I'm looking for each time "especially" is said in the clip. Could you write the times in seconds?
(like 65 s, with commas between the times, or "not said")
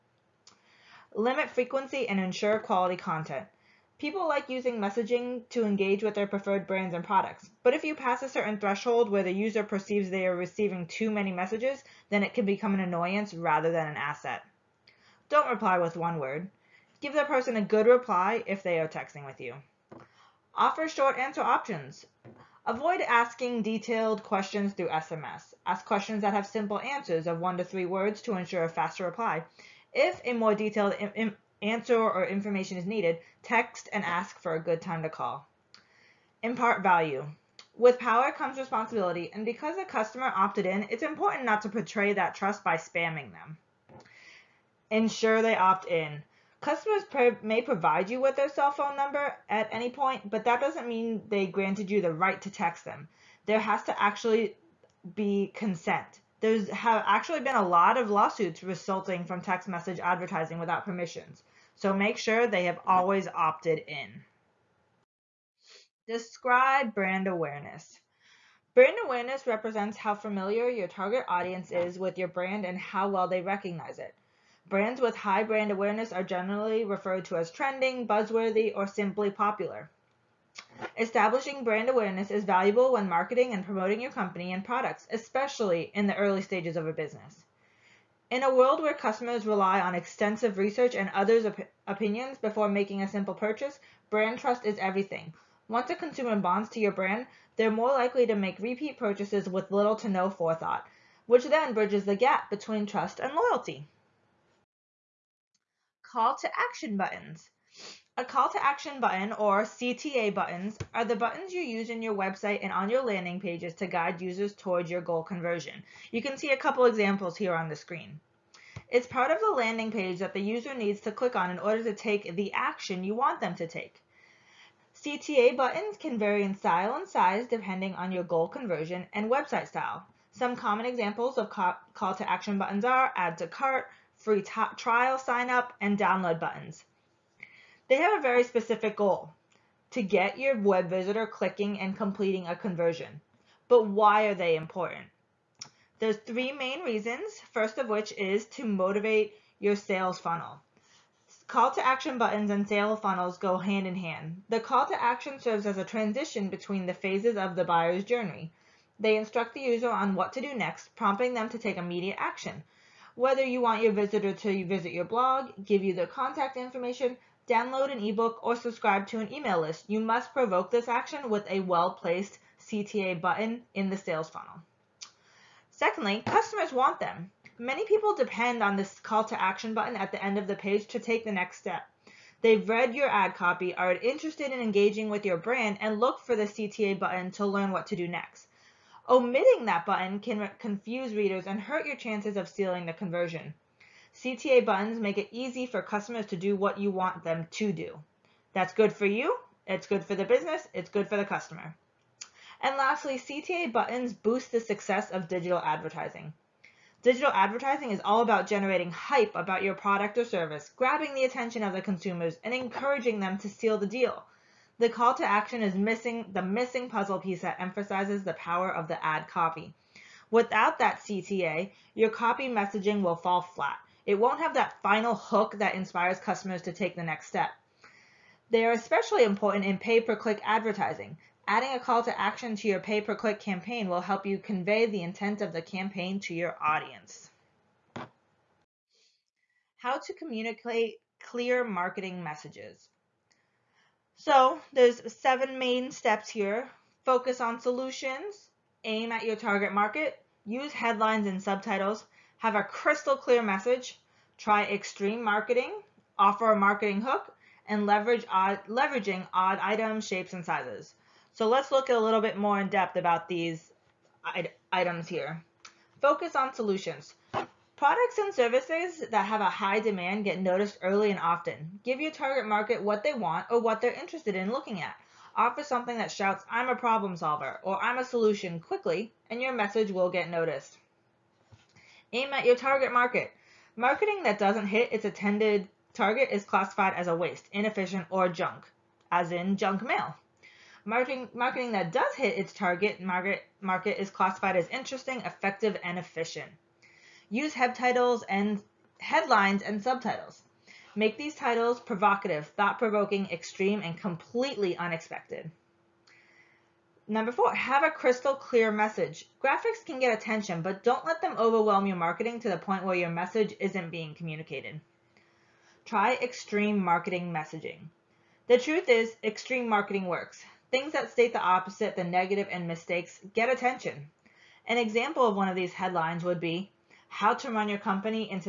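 85 s, 228 s.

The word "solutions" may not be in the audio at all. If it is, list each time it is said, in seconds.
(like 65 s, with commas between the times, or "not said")
247 s, 266 s, 278 s.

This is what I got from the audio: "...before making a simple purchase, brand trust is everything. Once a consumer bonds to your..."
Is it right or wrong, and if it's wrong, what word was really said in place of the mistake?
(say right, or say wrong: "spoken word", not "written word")
right.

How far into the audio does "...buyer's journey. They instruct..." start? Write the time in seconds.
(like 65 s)
157 s.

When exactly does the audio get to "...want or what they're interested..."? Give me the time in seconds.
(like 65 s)
273 s.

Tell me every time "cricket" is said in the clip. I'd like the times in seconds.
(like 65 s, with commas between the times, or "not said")
not said.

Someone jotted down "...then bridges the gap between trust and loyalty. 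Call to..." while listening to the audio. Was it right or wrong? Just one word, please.
right.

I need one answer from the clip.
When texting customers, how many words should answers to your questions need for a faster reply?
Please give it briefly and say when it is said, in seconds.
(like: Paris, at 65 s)
1 to 3 words, at 27 s.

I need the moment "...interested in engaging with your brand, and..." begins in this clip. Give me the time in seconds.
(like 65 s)
183 s.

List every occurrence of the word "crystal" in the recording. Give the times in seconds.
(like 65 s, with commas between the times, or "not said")
252 s, 307 s.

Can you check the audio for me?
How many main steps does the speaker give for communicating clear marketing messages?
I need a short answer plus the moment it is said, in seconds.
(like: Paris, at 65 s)
7, at 245 s.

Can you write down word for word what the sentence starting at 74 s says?
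Brands with high brand awareness are generally referred to as trending, buzzworthy, or simply popular.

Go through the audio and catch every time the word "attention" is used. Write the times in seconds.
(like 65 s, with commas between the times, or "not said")
211 s, 310 s, 323 s.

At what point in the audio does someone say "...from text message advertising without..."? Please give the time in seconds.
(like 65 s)
59 s.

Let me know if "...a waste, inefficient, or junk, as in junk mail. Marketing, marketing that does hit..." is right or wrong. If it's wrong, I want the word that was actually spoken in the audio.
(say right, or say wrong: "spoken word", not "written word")
right.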